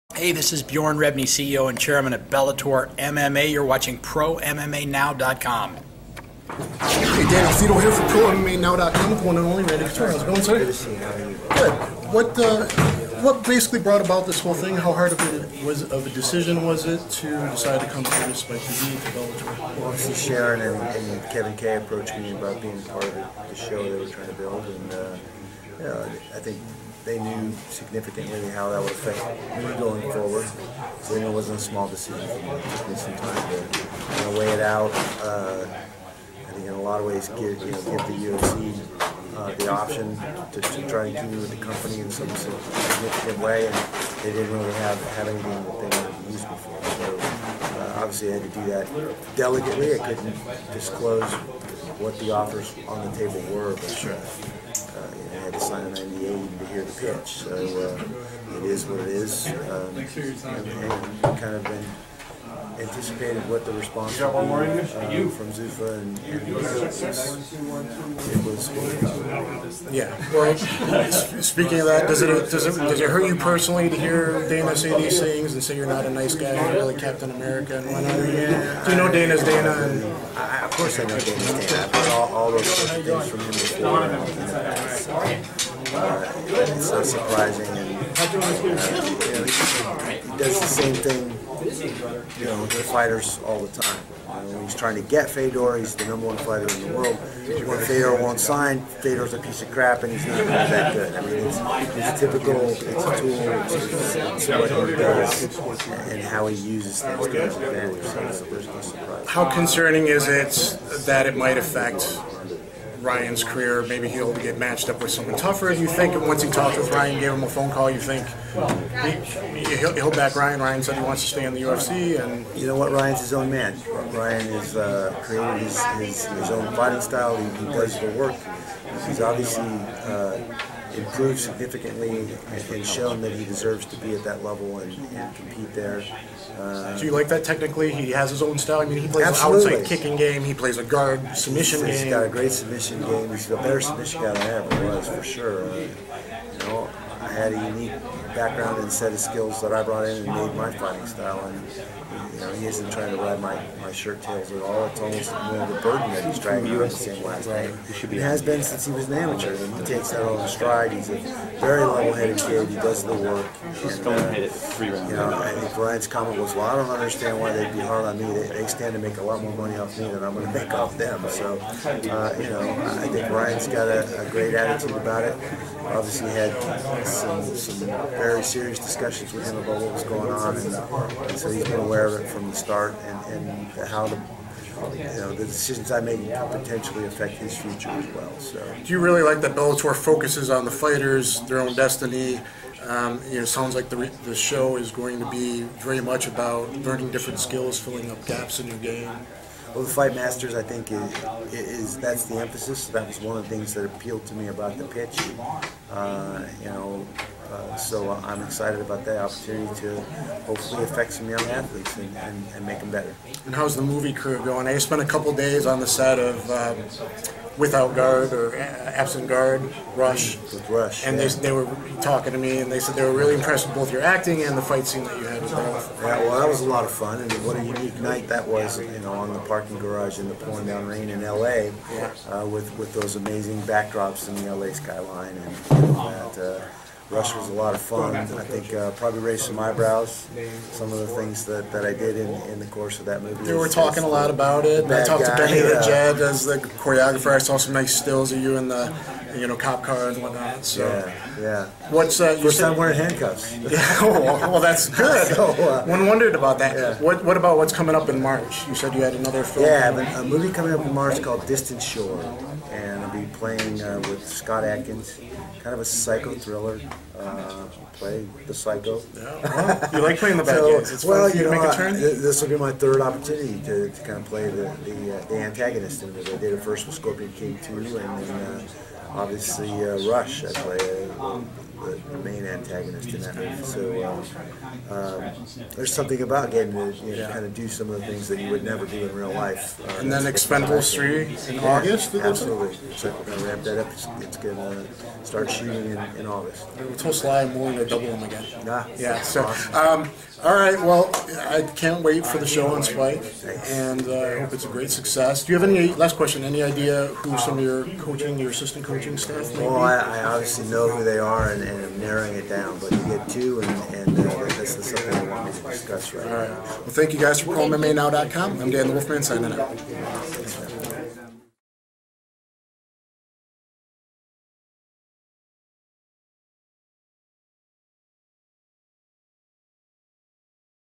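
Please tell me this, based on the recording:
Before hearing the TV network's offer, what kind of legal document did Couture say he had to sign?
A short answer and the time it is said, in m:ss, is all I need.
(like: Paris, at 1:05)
NDA, at 0:55.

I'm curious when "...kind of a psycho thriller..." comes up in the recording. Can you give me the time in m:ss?
4:25.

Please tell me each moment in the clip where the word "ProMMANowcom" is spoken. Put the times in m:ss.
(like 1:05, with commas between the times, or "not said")
0:03, 0:08.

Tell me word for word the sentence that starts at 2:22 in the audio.
He's got a great submission game.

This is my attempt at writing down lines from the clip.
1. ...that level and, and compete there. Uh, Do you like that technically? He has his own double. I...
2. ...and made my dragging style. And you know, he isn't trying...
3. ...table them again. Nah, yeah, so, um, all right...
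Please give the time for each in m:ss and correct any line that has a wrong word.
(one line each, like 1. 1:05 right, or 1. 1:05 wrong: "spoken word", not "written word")
1. 2:14 wrong: "style", not "double"
2. 2:30 wrong: "fighting", not "dragging"
3. 4:57 wrong: "double", not "table".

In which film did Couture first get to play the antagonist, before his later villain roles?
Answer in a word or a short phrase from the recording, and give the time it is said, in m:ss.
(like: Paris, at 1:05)
Scorpion King 2, at 4:36.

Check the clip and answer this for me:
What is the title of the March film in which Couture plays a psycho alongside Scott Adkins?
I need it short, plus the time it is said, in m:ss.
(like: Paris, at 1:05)
Distant Shore, at 4:21.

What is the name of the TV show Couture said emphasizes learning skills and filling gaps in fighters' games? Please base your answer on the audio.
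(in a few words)
Fight Masters.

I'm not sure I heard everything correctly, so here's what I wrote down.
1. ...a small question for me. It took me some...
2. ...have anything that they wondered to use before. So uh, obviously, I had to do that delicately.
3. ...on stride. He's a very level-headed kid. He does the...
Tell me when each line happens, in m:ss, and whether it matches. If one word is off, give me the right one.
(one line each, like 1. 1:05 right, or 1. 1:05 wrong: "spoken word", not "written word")
1. 0:31 wrong: "decision", not "question"
2. 0:45 wrong: "wanted", not "wondered"
3. 2:40 right.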